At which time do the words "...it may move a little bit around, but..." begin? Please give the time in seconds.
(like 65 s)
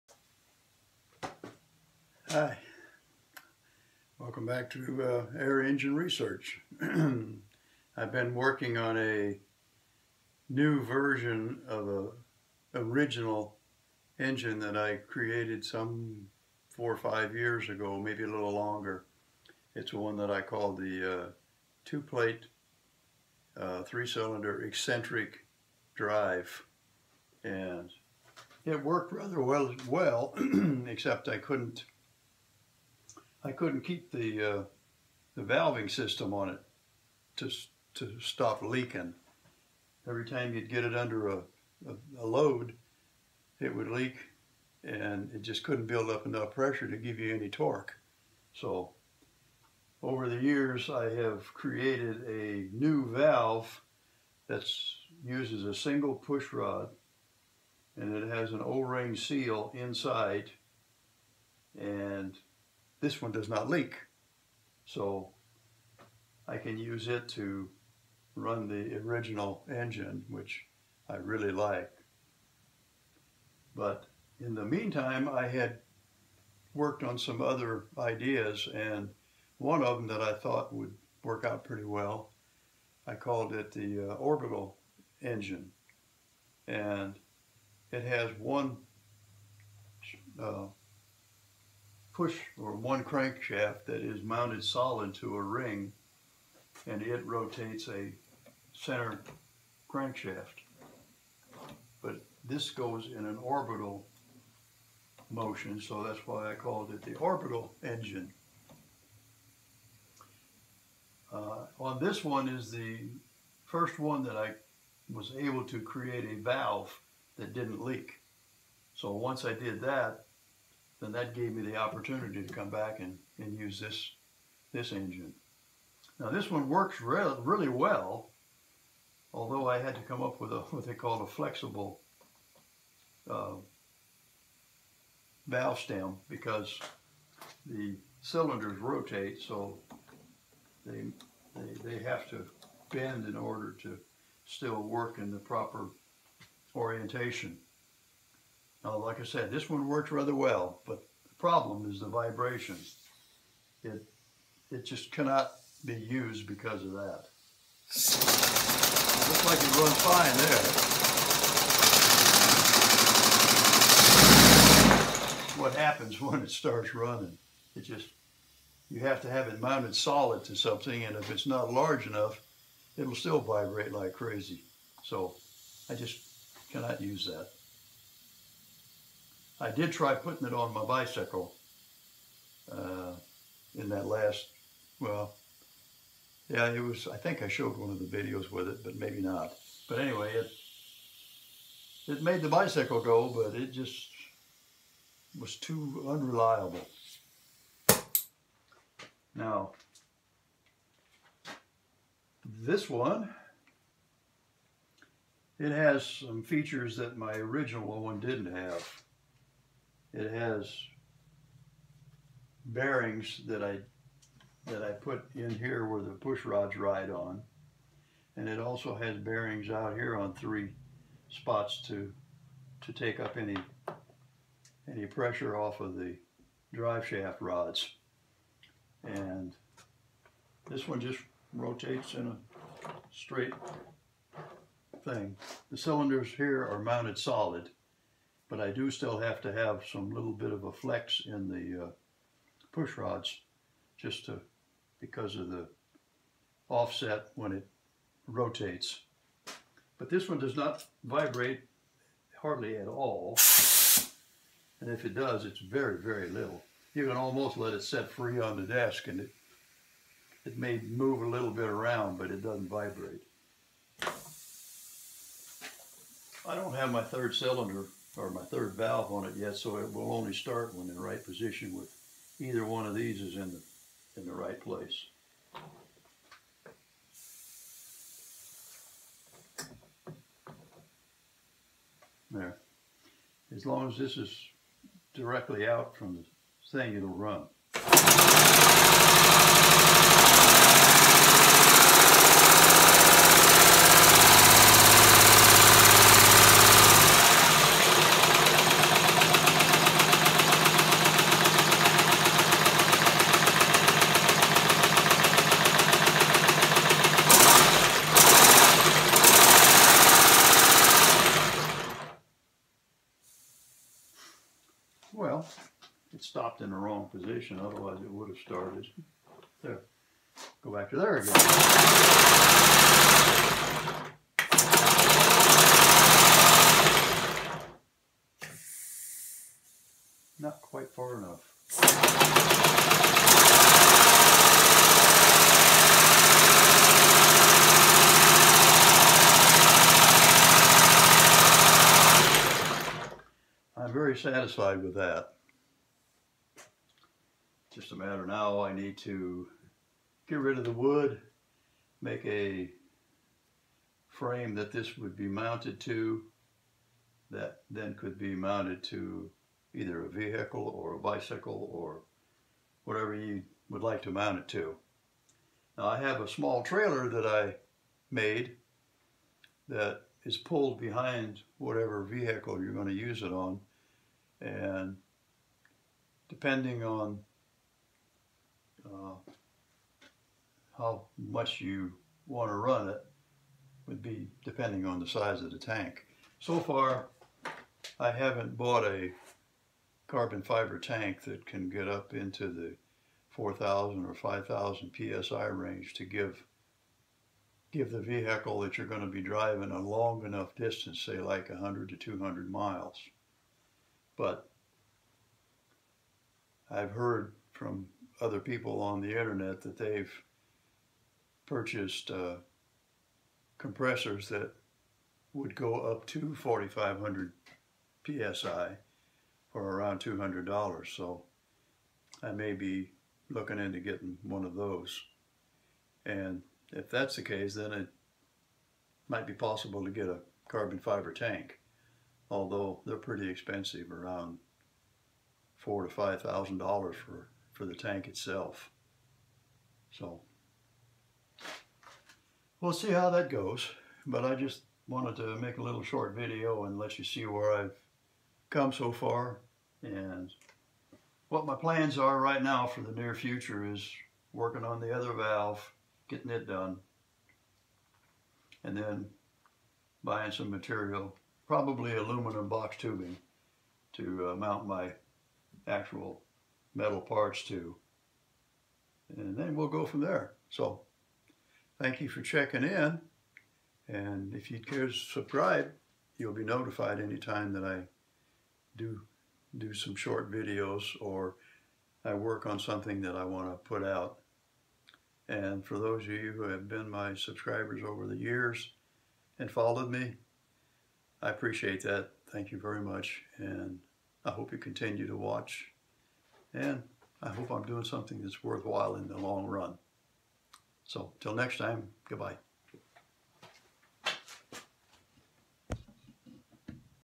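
260 s.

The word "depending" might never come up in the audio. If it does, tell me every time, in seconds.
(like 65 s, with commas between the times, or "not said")
376 s, 384 s.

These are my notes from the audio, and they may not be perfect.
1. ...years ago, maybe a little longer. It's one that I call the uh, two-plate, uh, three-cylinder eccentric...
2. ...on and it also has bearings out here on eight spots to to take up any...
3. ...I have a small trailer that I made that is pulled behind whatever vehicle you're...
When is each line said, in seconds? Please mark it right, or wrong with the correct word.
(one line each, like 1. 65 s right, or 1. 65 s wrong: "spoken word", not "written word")
1. 17 s right
2. 217 s wrong: "three", not "eight"
3. 365 s right.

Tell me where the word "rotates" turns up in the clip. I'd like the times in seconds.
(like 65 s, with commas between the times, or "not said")
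97 s, 138 s, 231 s, 248 s.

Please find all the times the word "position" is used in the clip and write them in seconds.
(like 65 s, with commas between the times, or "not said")
271 s, 317 s.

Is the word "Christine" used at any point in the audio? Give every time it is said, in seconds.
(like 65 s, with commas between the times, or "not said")
not said.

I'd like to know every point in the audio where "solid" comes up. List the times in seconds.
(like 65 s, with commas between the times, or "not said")
94 s, 169 s, 237 s.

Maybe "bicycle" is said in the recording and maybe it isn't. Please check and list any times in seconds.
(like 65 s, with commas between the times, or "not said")
180 s, 192 s, 360 s.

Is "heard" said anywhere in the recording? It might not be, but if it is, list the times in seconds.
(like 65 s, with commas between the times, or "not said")
406 s.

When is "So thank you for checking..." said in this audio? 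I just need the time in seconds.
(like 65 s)
470 s.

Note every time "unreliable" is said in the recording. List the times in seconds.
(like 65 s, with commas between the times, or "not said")
196 s.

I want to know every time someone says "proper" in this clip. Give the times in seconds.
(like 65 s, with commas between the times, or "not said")
145 s.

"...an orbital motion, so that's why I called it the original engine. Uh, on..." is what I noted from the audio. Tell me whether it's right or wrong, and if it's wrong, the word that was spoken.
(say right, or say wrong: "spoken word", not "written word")
wrong: "orbital", not "original".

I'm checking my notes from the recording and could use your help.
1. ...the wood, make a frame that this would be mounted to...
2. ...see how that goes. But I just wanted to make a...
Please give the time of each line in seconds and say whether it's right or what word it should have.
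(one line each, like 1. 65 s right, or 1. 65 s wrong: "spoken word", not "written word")
1. 350 s right
2. 442 s right.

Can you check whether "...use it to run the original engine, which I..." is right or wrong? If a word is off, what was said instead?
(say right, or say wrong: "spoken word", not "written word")
right.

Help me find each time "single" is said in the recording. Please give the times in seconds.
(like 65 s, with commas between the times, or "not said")
55 s.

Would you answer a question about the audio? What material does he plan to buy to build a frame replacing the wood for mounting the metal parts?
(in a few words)
aluminum box tubing.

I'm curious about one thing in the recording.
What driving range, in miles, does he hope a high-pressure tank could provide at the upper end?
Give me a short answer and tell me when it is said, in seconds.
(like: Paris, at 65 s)
200 miles, at 401 s.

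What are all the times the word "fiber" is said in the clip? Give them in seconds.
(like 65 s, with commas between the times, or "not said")
390 s, 430 s.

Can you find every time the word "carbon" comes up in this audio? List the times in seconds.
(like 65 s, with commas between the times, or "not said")
390 s, 430 s.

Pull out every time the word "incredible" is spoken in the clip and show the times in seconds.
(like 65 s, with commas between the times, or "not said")
not said.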